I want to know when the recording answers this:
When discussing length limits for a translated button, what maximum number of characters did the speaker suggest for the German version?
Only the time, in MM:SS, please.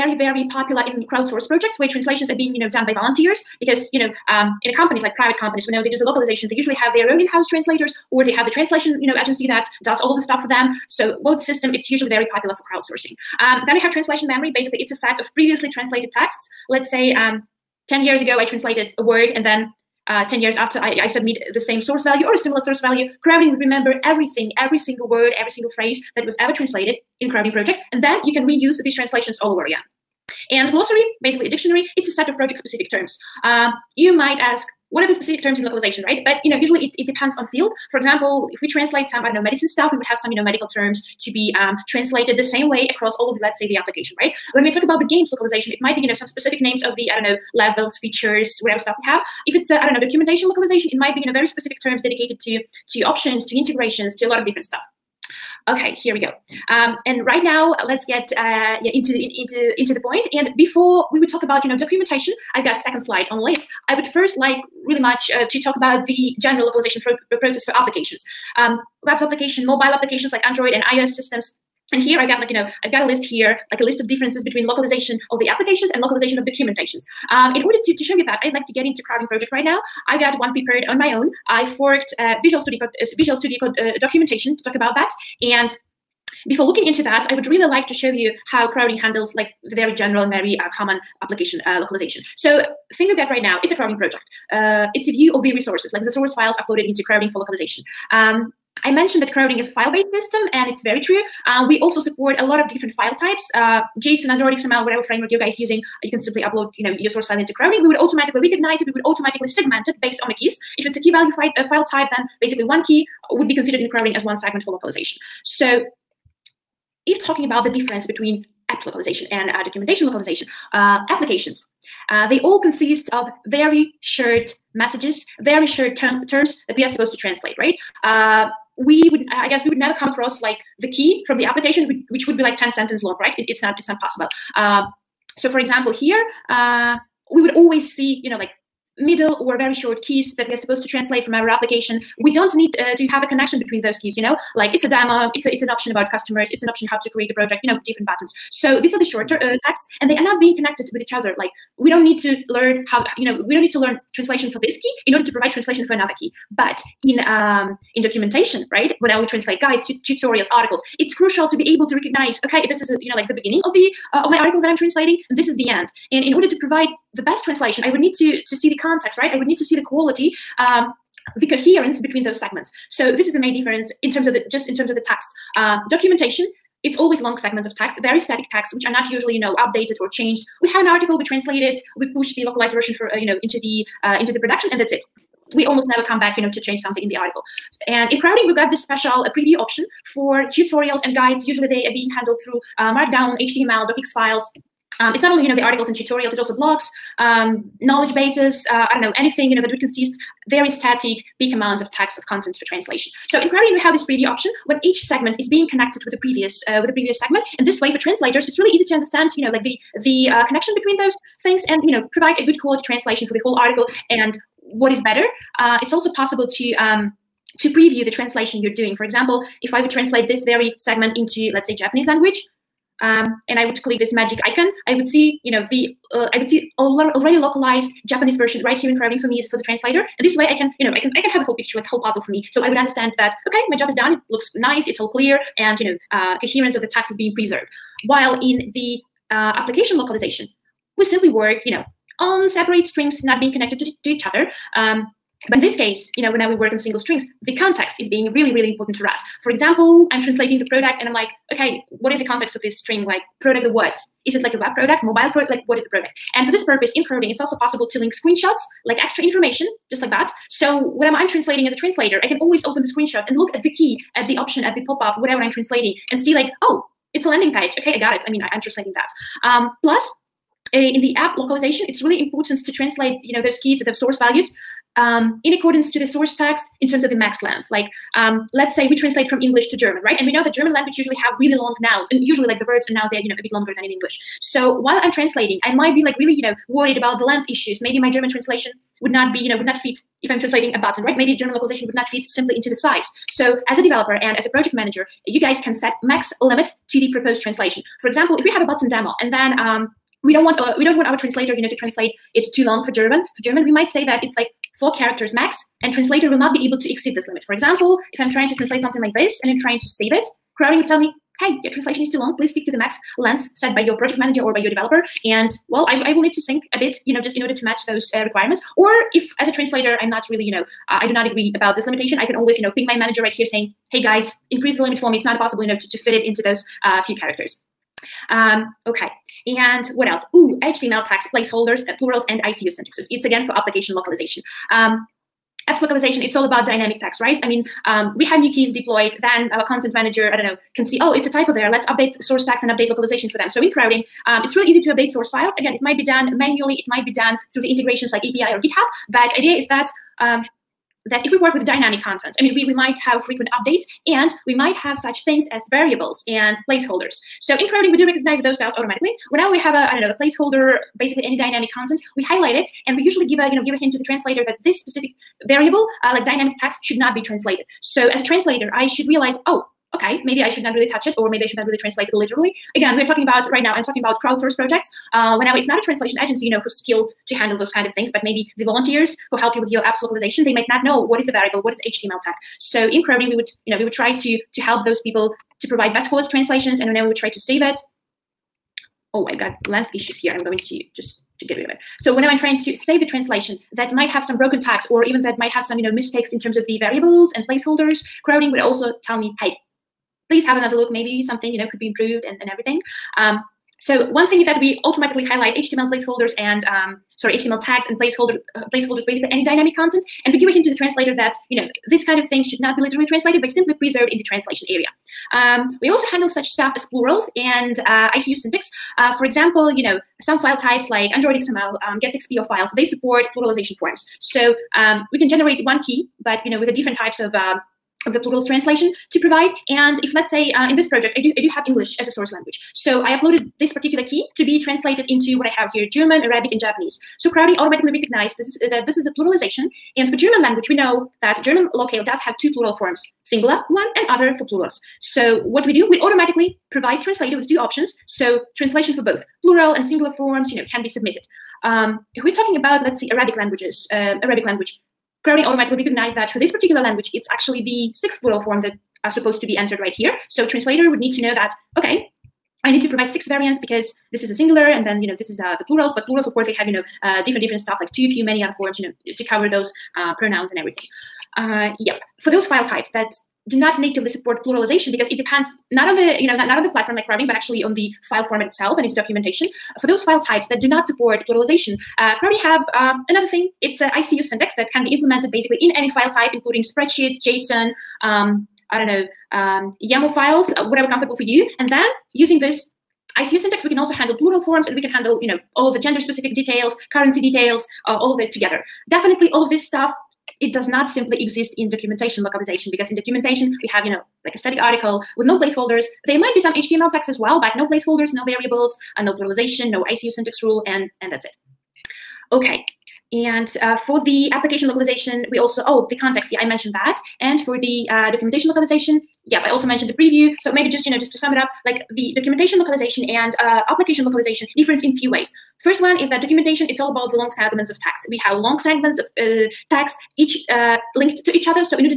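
05:04.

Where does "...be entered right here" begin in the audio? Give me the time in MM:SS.
07:39.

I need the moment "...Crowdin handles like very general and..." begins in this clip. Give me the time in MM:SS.
01:28.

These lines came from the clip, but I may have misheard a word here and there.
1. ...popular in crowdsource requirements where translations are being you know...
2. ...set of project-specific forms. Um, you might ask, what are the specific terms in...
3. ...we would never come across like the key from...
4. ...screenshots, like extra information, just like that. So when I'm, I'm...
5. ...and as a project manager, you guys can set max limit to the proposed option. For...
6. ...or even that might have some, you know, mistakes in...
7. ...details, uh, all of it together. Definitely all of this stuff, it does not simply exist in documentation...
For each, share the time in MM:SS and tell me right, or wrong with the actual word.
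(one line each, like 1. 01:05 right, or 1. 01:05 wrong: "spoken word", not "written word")
1. 00:00 wrong: "projects", not "requirements"
2. 00:32 wrong: "terms", not "forms"
3. 02:09 right
4. 04:18 right
5. 04:54 wrong: "translation", not "option"
6. 06:34 right
7. 08:17 right.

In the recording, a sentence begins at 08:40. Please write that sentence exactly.
So maybe just, you know, just to sum it up, like the documentation localization and uh, application localization difference in few ways.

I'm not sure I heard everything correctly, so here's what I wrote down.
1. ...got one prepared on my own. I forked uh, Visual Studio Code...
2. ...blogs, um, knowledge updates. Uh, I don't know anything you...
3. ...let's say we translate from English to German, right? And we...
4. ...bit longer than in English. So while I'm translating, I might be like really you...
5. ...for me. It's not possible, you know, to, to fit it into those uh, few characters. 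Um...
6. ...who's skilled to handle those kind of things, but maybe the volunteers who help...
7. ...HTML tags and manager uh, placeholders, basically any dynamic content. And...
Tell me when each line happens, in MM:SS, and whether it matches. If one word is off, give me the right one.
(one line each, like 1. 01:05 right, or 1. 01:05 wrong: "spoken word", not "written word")
1. 01:20 right
2. 03:16 wrong: "bases", not "updates"
3. 04:38 right
4. 04:43 right
5. 05:24 right
6. 06:16 right
7. 06:47 wrong: "placeholder", not "manager".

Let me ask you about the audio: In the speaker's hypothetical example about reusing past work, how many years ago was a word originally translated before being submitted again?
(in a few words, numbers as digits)
10.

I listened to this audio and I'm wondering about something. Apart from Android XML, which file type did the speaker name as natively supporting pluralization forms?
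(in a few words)
GetXPO files.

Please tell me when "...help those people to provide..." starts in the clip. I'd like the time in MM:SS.
06:24.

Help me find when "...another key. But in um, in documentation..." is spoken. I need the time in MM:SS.
02:35.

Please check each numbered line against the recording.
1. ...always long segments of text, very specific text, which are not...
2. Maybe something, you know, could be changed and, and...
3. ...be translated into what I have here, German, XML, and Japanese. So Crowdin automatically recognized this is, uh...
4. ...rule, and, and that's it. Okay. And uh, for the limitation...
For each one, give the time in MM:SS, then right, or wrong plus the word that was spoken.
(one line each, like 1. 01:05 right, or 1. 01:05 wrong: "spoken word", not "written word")
1. 02:56 wrong: "static", not "specific"
2. 06:40 wrong: "improved", not "changed"
3. 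07:14 wrong: "Arabic", not "XML"
4. 08:30 wrong: "application", not "limitation".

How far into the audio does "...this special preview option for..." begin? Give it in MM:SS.
03:08.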